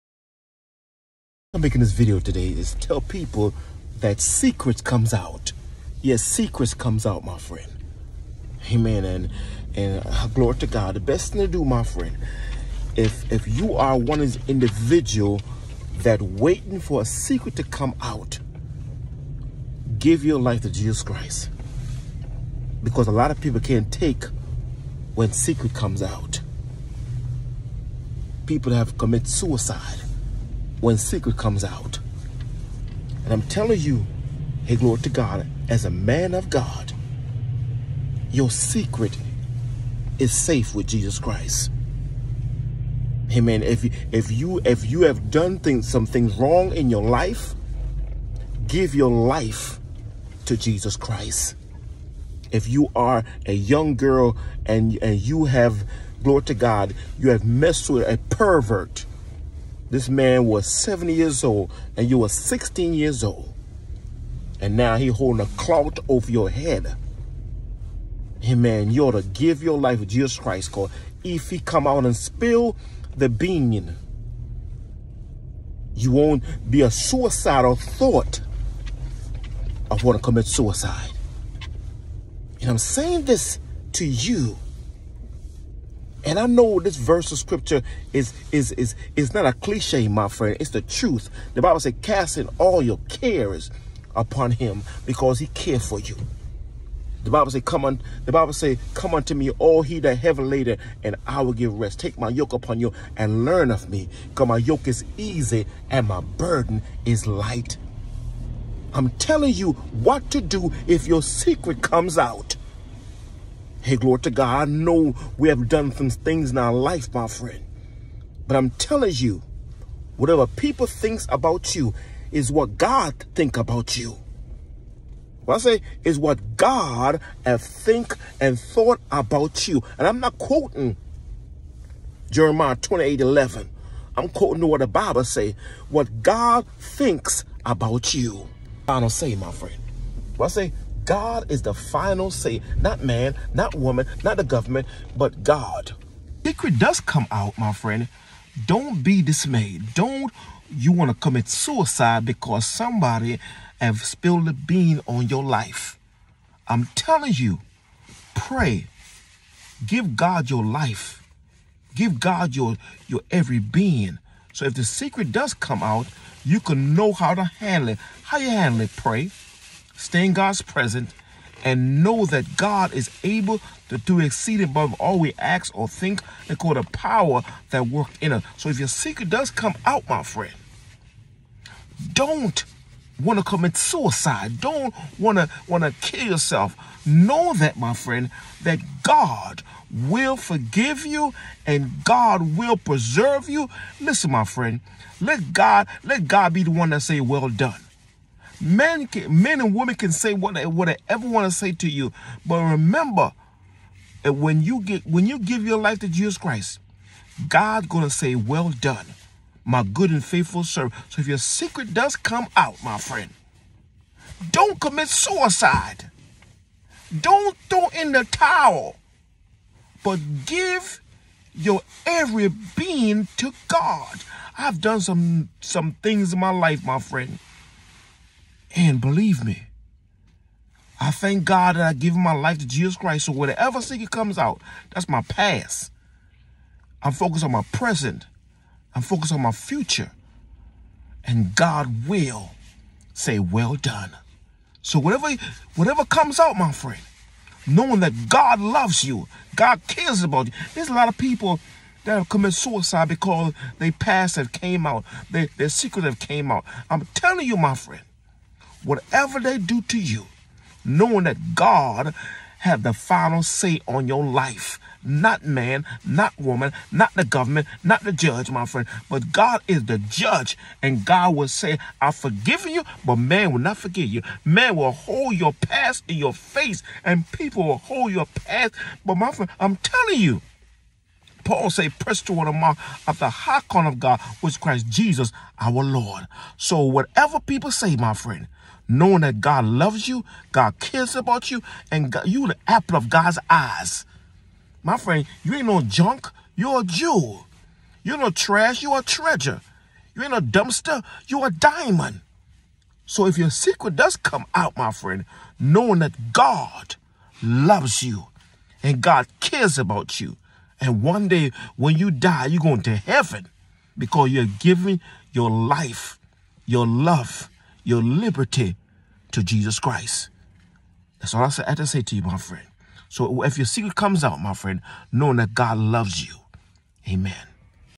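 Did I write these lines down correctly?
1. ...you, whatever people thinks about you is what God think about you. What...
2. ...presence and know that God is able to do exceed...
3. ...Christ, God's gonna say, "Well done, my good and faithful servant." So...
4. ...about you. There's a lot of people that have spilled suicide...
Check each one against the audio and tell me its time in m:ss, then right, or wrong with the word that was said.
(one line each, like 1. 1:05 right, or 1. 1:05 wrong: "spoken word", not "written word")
1. 1:59 right
2. 2:50 right
3. 3:26 right
4. 4:10 wrong: "committed", not "spilled".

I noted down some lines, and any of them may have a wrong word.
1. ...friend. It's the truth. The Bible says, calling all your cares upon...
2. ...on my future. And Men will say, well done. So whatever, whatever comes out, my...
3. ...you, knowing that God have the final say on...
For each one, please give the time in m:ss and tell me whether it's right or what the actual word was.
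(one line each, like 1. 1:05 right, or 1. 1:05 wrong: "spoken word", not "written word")
1. 1:30 wrong: "casting", not "calling"
2. 3:59 wrong: "God", not "Men"
3. 4:19 right.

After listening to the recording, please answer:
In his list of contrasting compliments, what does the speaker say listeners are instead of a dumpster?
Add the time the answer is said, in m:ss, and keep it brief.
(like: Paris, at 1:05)
A diamond, at 5:01.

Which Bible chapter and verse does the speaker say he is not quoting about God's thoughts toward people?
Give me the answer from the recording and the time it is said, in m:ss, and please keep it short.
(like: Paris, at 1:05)
Jeremiah 28:11, at 2:12.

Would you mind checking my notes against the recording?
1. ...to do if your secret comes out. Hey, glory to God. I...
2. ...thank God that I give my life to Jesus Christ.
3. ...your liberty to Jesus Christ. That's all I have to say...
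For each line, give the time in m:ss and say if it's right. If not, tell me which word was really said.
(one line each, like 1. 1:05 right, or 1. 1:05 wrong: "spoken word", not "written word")
1. 1:50 right
2. 3:51 right
3. 5:17 right.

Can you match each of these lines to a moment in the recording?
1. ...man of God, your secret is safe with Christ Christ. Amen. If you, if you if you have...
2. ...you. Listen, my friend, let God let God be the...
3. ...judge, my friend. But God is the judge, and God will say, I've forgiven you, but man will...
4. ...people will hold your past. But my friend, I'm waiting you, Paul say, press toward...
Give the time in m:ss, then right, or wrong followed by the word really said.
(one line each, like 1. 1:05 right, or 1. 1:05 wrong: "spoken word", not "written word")
1. 0:35 wrong: "Jesus", not "Christ"
2. 3:13 right
3. 4:28 right
4. 4:37 wrong: "telling", not "waiting".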